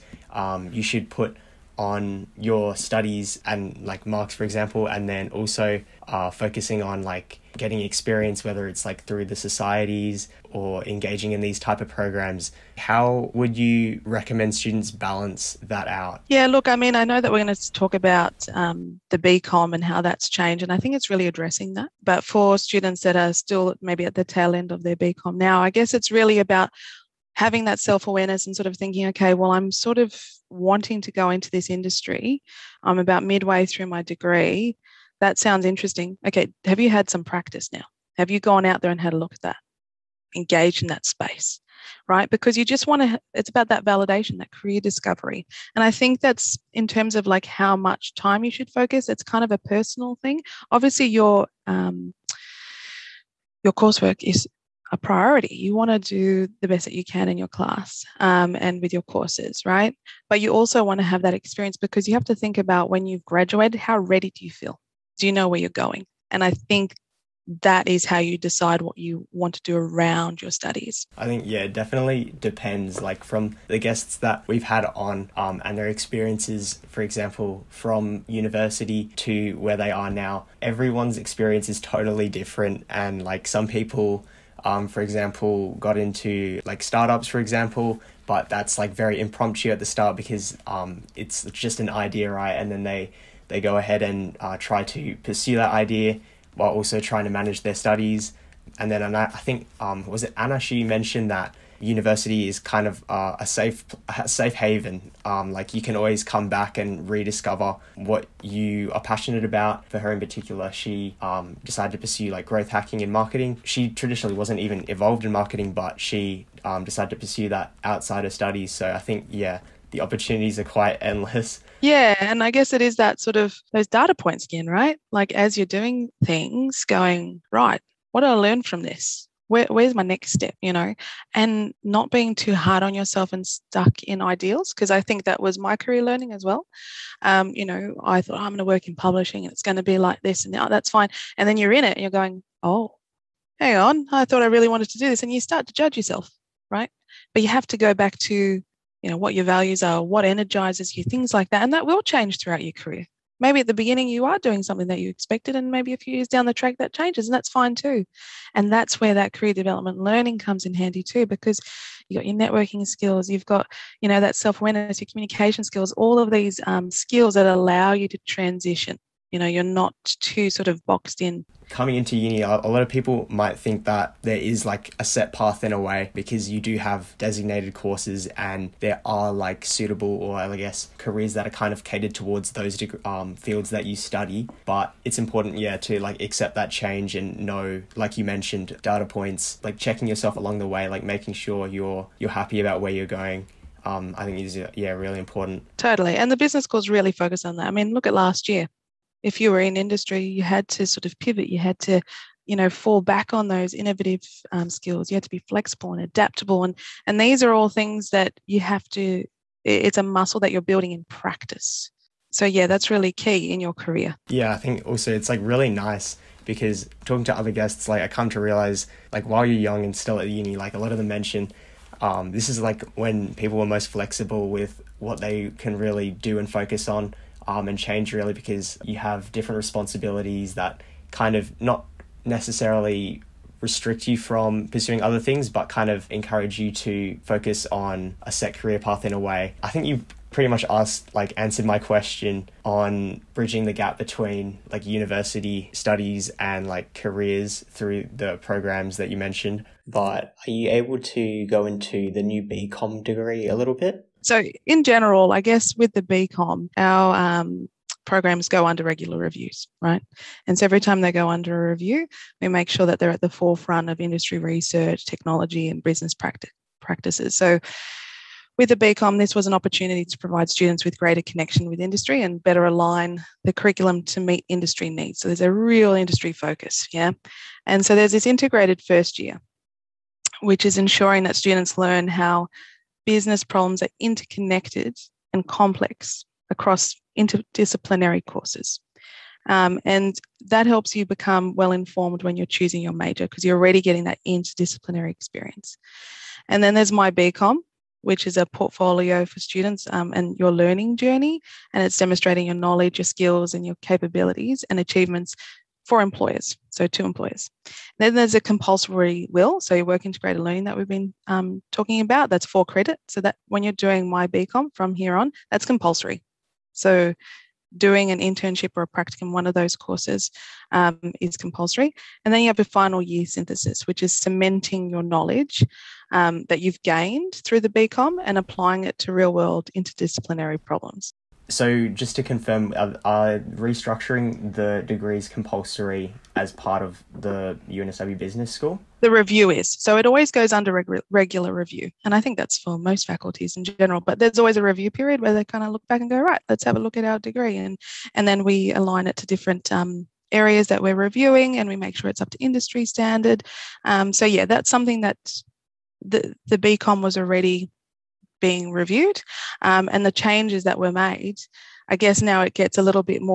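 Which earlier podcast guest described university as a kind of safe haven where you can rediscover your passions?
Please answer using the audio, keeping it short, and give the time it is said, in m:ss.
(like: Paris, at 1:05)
Anna, at 1:40.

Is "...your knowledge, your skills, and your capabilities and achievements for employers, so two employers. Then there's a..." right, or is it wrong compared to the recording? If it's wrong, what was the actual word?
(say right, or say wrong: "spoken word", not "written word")
right.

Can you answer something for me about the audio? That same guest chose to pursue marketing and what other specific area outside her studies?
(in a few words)
growth hacking.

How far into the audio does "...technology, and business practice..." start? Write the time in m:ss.
4:25.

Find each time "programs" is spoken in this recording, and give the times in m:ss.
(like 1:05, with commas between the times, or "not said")
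0:11, 4:08, 4:18.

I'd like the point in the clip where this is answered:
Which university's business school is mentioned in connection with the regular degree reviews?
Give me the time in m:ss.
5:37.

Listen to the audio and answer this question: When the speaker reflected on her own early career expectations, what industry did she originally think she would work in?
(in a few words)
publishing.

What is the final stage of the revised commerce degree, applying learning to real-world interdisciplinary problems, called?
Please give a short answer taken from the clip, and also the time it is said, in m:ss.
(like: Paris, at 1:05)
final year synthesis, at 5:22.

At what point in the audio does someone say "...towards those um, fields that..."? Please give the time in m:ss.
3:02.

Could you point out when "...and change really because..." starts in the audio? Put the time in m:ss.
3:47.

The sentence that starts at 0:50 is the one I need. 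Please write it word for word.
Obviously, your, um, your coursework is a priority.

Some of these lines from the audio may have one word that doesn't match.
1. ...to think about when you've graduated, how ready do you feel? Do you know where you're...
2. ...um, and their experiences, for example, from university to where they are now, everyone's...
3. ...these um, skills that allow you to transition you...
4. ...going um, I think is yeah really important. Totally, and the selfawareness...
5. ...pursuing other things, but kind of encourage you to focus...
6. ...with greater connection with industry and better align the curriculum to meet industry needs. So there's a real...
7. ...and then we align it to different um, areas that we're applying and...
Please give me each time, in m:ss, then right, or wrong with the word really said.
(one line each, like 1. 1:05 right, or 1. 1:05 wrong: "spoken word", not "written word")
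1. 1:02 right
2. 1:15 right
3. 2:46 right
4. 3:13 wrong: "business", not "selfawareness"
5. 3:54 right
6. 4:30 right
7. 5:48 wrong: "reviewing", not "applying".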